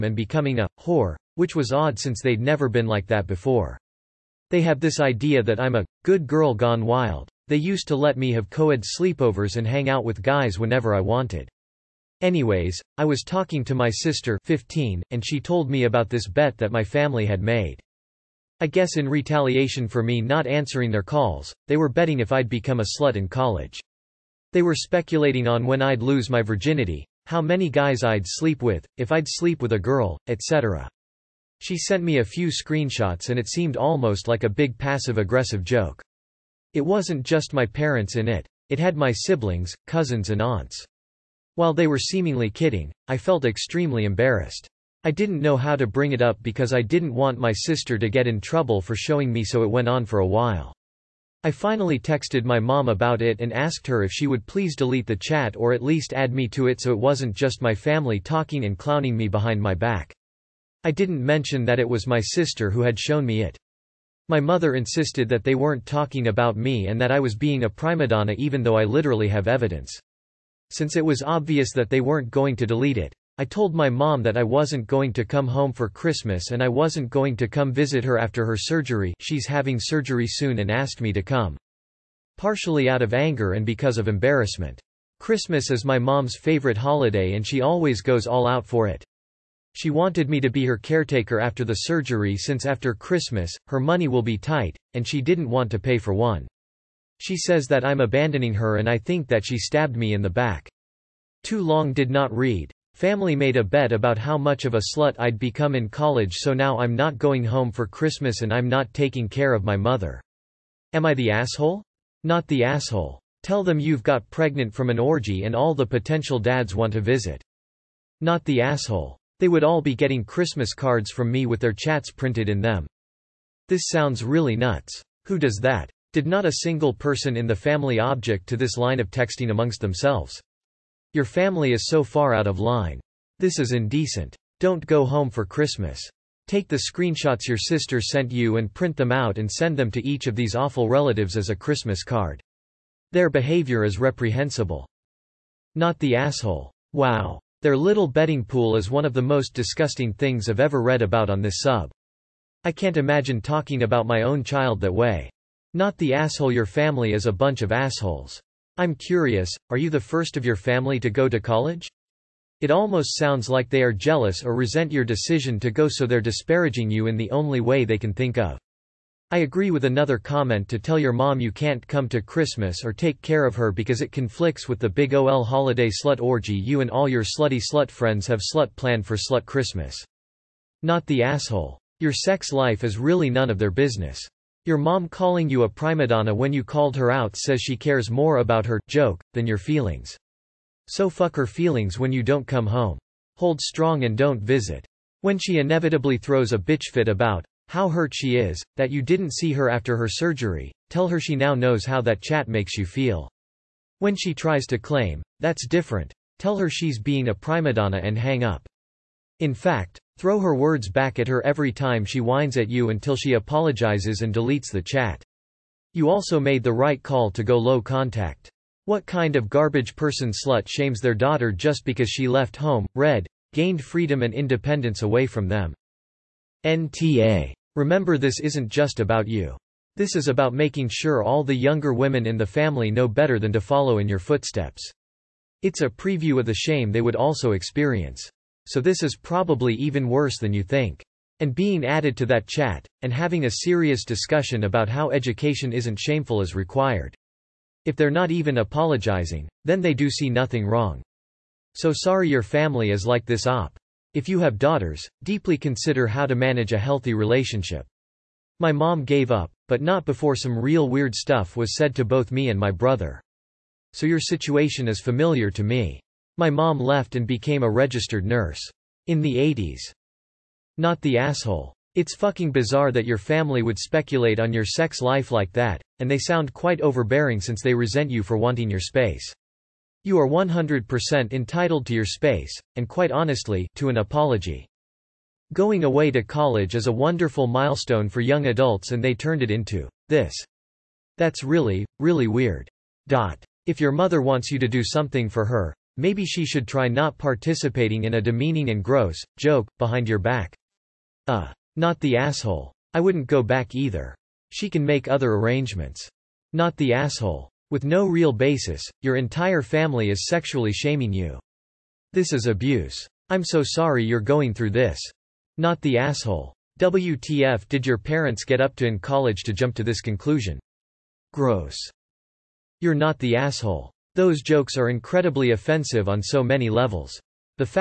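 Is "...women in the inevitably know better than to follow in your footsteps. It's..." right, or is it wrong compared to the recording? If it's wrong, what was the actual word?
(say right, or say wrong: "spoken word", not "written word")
wrong: "family", not "inevitably".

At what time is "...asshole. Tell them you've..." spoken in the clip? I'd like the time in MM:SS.
01:52.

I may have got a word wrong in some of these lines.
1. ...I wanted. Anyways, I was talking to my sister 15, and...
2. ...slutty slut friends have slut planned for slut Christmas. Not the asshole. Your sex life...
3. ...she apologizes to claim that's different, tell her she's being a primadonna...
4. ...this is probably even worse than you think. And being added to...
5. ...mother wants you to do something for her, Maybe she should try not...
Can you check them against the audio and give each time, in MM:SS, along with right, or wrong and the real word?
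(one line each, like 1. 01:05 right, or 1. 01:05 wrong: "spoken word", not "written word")
1. 00:10 right
2. 02:57 right
3. 03:24 wrong: "tries", not "apologizes"
4. 03:58 right
5. 04:53 right.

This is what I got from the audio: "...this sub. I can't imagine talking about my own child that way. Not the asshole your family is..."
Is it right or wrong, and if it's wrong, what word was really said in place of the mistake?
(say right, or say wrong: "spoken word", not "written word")
right.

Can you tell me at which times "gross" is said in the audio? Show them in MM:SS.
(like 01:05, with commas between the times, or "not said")
04:58, 05:21.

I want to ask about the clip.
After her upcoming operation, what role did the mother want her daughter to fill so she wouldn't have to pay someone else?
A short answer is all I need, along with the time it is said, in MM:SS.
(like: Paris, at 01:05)
caretaker, at 01:30.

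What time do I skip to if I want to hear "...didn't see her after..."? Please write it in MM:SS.
03:19.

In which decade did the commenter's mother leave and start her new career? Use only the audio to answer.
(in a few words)
the 80s.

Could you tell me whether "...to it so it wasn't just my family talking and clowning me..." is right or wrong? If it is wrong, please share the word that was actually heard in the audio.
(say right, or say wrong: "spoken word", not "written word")
right.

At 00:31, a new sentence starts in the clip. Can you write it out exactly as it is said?
She sent me a few screenshots and it seemed almost like a big passive-aggressive joke.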